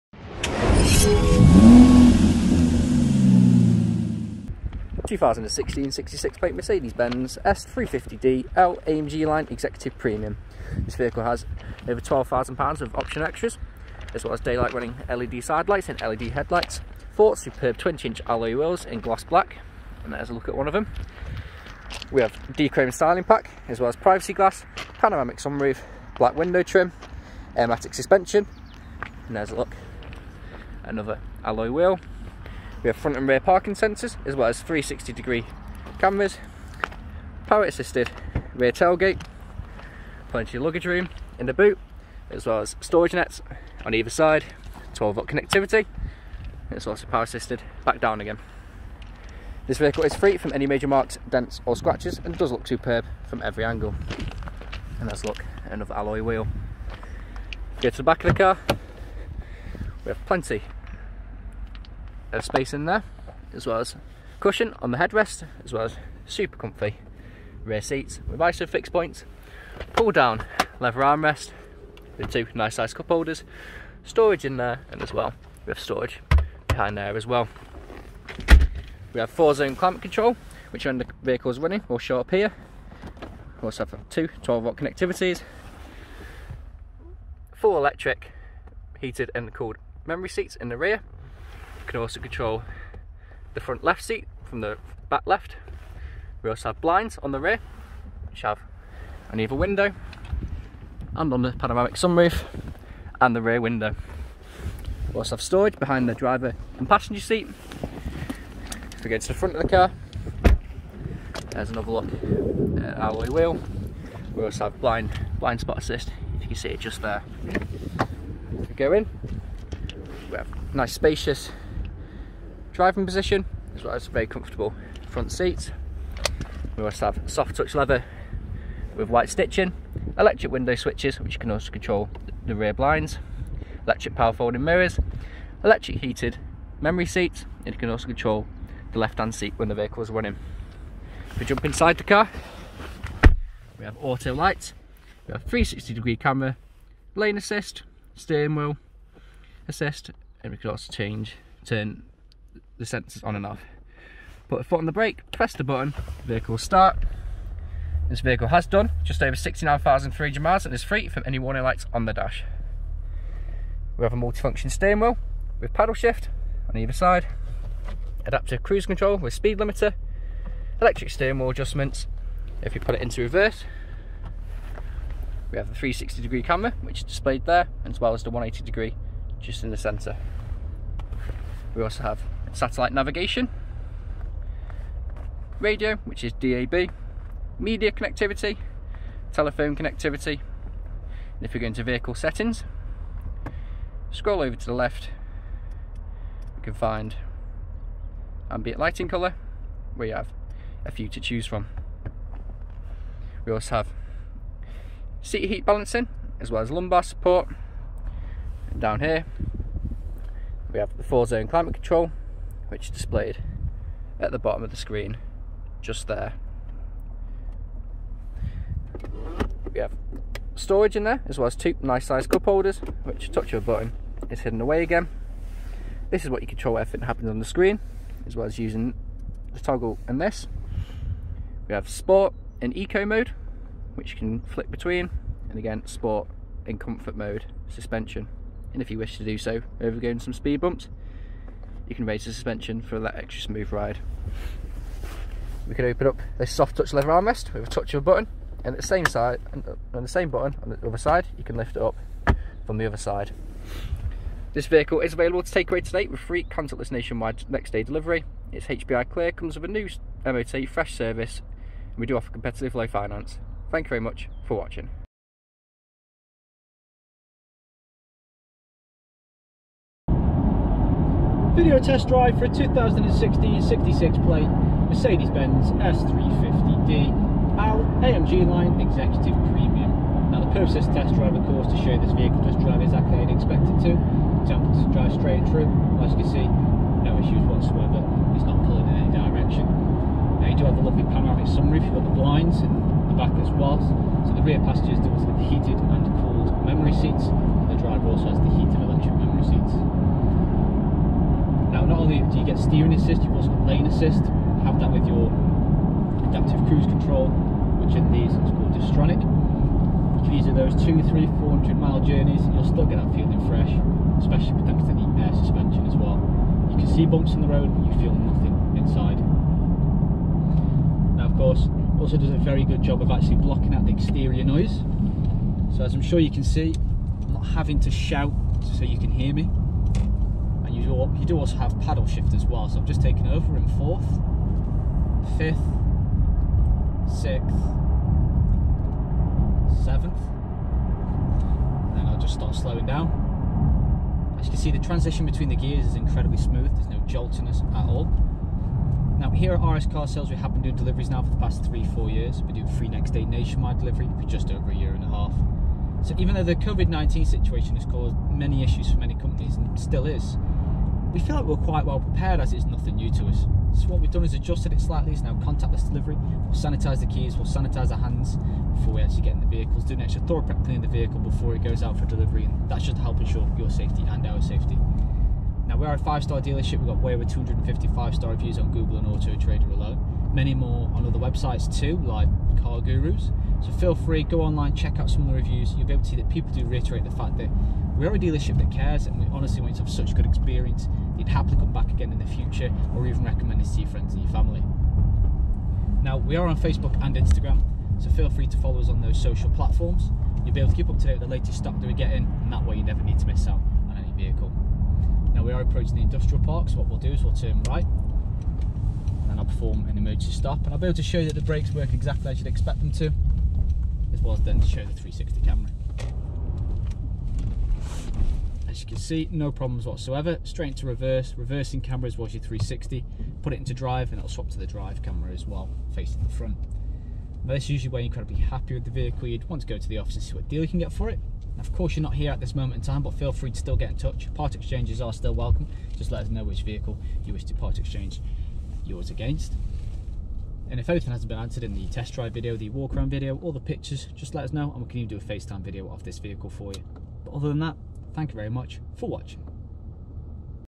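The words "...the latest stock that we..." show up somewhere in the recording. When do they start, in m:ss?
6:41.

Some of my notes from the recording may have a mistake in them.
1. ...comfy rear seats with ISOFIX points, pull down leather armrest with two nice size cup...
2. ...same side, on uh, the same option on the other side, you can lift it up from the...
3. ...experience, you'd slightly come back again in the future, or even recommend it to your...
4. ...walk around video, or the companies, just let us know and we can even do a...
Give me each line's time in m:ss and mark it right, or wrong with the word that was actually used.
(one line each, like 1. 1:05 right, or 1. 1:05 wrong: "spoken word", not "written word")
1. 1:06 right
2. 4:08 wrong: "button", not "option"
3. 6:30 wrong: "happily", not "slightly"
4. 7:22 wrong: "pictures", not "companies".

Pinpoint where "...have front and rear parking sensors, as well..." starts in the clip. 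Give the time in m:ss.
0:32.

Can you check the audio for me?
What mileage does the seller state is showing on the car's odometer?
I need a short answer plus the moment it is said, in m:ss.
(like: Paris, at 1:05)
69,300 miles, at 2:39.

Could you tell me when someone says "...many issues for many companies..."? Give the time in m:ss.
5:58.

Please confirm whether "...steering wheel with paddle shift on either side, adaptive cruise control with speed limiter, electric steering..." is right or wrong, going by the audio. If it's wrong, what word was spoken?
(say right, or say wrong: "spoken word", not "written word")
right.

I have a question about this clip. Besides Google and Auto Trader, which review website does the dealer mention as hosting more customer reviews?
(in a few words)
Car Gurus.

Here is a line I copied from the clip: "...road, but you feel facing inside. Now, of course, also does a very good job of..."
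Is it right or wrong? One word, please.
wrong.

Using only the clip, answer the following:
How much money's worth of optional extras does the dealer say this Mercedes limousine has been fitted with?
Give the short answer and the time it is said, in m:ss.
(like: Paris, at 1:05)
£12,000, at 0:11.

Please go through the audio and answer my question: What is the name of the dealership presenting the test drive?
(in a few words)
RS Car Sales.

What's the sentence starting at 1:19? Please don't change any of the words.
We have four zone climate control, which when the vehicle's running will show up here.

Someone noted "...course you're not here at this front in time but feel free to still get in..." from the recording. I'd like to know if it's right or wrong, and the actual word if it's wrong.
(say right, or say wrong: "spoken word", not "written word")
wrong: "moment", not "front".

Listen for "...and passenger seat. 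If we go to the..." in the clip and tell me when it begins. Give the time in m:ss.
1:46.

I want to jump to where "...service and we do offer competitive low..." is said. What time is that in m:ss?
4:20.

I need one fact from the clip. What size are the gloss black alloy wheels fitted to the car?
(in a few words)
20-inch.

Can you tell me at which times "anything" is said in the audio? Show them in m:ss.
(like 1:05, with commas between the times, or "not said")
7:20.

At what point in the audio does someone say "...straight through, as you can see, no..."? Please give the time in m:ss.
4:45.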